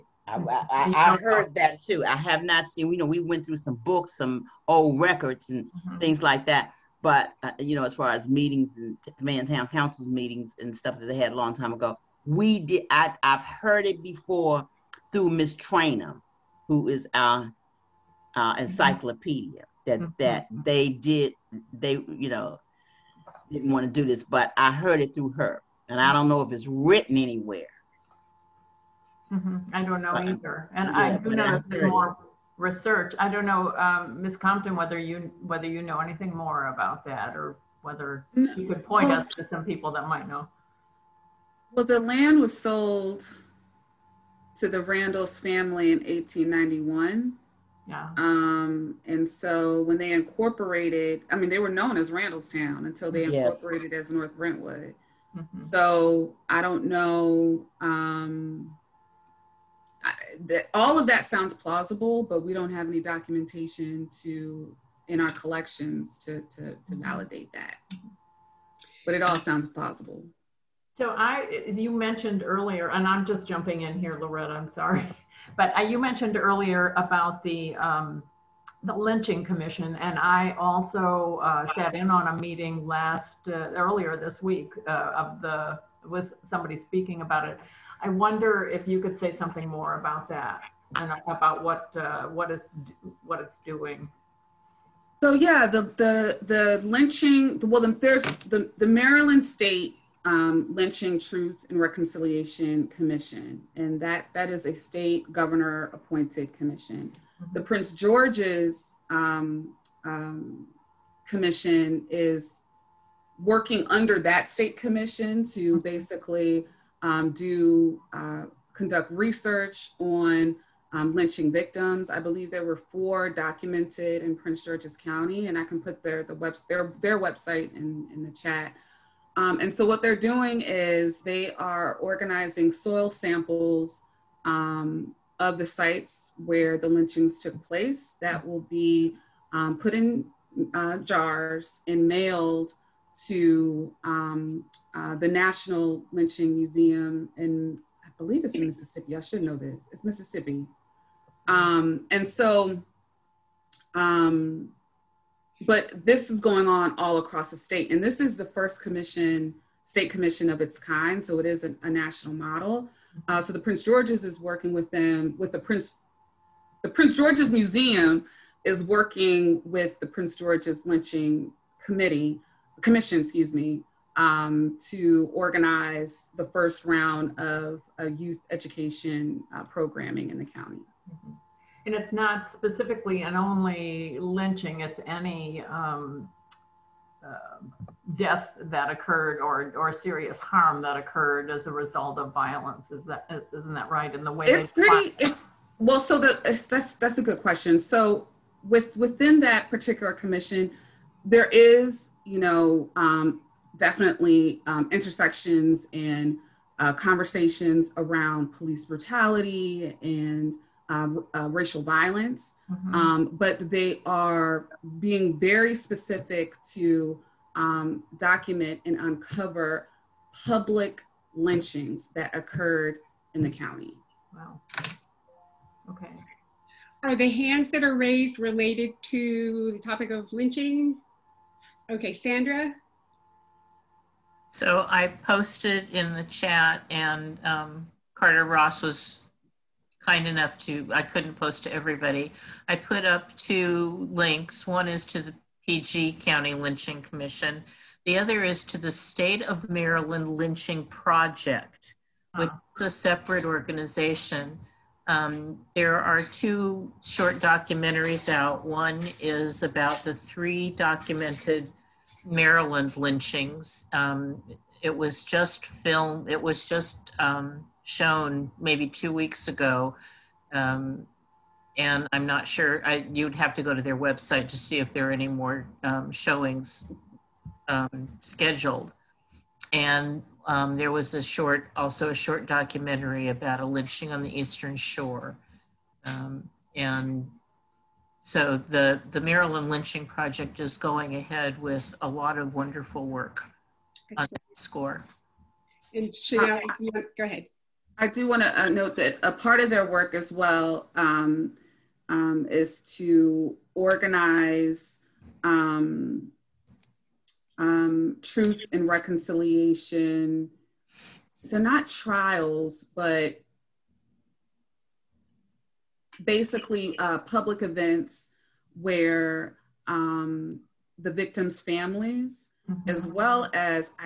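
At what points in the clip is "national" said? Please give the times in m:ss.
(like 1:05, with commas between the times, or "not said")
2:25, 2:41.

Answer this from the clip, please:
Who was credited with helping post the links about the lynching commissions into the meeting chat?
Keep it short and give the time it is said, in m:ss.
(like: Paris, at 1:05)
Carter Ross, at 3:58.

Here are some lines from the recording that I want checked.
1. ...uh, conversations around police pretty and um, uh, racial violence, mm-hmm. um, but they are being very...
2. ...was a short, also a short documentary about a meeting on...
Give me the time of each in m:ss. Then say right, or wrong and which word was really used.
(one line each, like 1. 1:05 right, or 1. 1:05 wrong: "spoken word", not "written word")
1. 3:26 wrong: "brutality", not "pretty"
2. 4:40 wrong: "lynching", not "meeting".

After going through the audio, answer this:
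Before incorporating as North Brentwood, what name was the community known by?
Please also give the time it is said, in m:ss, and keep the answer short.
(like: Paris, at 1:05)
Randallstown, at 0:52.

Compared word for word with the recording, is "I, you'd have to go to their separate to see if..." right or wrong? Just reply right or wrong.
wrong.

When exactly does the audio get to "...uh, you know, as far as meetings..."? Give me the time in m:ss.
0:07.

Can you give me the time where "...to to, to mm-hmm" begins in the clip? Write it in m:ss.
1:06.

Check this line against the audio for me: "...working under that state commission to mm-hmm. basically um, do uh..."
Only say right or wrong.
right.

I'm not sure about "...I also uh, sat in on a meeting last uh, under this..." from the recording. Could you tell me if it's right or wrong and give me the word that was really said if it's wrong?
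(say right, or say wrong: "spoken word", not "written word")
wrong: "earlier", not "under".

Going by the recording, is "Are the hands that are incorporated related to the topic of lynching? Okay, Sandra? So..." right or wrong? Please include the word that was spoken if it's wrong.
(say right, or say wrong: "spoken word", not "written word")
wrong: "raised", not "incorporated".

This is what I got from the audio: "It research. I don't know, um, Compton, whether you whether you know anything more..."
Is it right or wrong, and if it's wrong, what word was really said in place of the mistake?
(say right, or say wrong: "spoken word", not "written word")
right.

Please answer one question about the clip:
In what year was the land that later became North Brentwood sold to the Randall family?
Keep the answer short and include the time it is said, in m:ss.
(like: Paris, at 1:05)
1891, at 0:45.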